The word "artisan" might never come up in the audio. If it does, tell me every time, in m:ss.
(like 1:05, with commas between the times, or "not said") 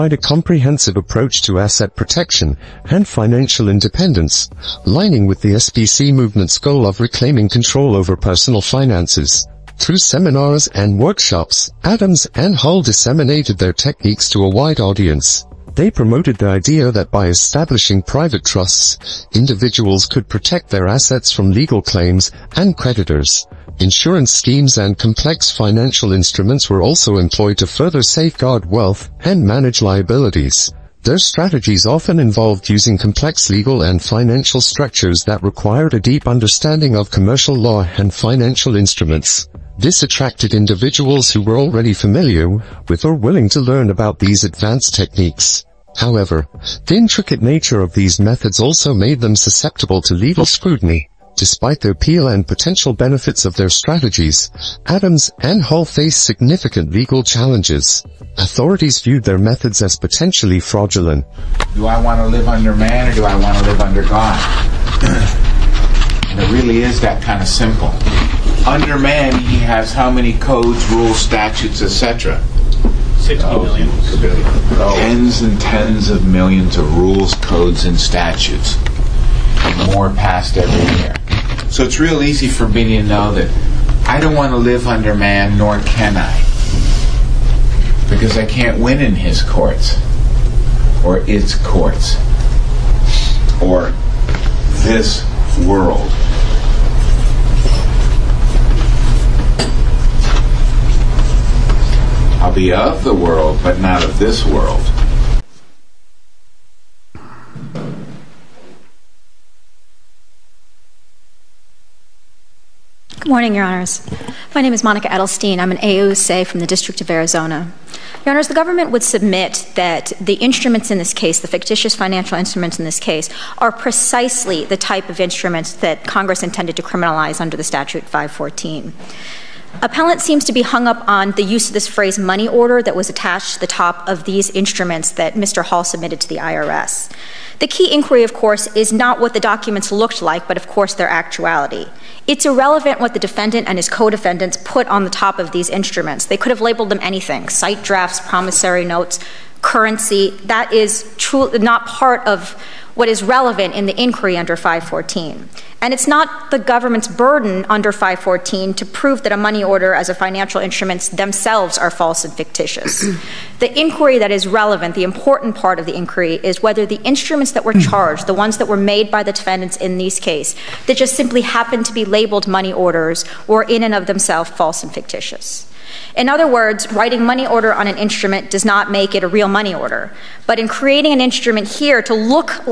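not said.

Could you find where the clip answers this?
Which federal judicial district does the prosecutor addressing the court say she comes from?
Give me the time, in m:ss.
1:56.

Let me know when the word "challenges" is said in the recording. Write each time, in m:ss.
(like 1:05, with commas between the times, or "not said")
0:57.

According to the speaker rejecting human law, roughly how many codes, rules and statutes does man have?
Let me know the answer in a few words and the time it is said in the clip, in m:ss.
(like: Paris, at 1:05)
60 million, at 1:13.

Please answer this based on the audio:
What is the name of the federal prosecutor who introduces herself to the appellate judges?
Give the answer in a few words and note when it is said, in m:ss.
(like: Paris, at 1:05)
Monica Edelstein, at 1:54.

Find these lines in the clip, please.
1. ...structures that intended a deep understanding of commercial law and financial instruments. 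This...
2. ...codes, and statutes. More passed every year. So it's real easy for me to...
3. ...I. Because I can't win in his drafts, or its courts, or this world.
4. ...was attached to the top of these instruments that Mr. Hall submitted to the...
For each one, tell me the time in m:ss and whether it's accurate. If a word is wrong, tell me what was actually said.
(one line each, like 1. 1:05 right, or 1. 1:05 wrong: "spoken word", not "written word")
1. 0:34 wrong: "required", not "intended"
2. 1:17 right
3. 1:26 wrong: "courts", not "drafts"
4. 2:12 right.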